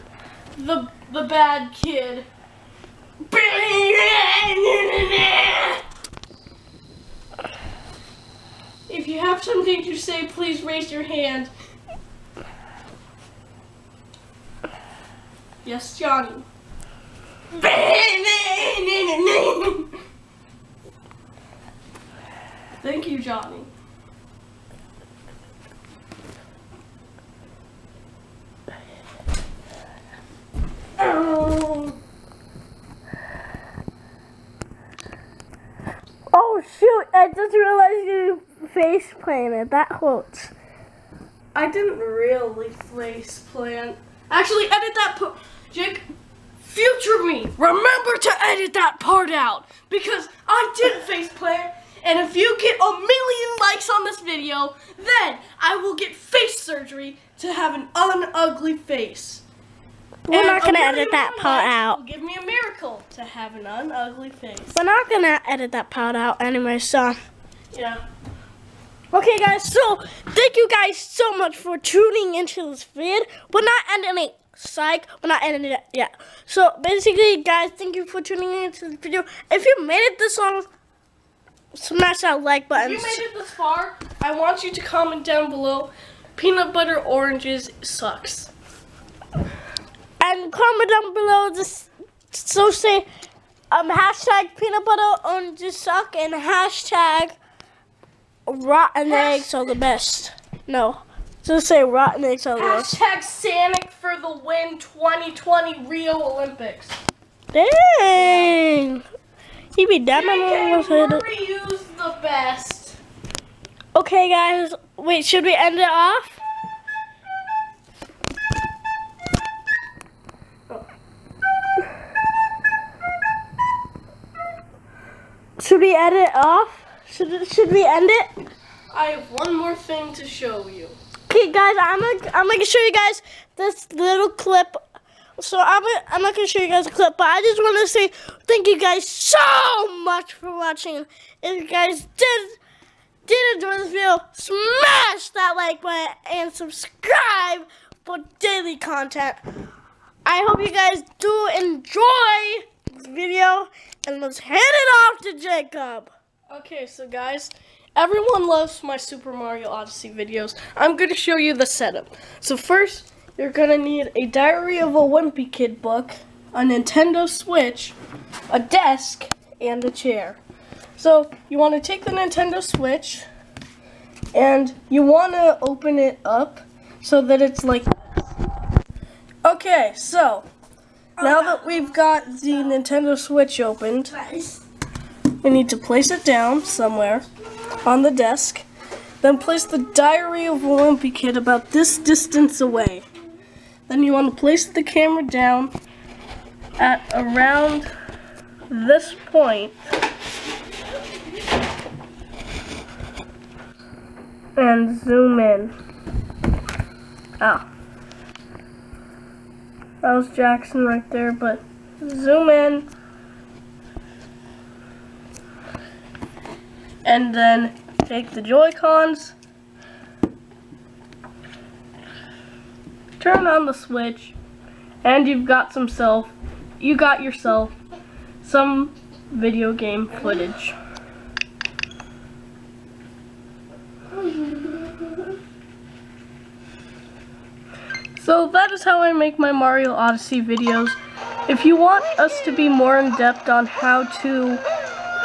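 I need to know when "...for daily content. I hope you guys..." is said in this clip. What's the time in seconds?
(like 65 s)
148 s.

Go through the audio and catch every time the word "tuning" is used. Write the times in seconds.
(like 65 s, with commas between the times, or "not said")
71 s, 78 s.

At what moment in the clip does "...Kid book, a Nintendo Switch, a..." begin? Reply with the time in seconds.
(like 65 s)
165 s.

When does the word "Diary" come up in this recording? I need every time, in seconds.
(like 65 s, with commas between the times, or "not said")
164 s, 189 s.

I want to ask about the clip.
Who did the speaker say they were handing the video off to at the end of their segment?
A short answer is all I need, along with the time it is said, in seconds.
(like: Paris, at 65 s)
Jacob, at 155 s.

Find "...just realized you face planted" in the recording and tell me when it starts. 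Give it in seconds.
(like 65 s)
37 s.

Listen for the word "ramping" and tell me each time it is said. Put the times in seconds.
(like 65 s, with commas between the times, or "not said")
not said.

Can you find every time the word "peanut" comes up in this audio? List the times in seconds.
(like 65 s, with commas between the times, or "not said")
86 s, 94 s.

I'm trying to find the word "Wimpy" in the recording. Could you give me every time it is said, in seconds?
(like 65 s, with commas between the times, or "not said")
164 s, 190 s.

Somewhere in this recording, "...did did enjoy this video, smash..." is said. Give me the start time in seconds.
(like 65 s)
142 s.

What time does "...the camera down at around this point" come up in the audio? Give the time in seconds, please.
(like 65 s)
194 s.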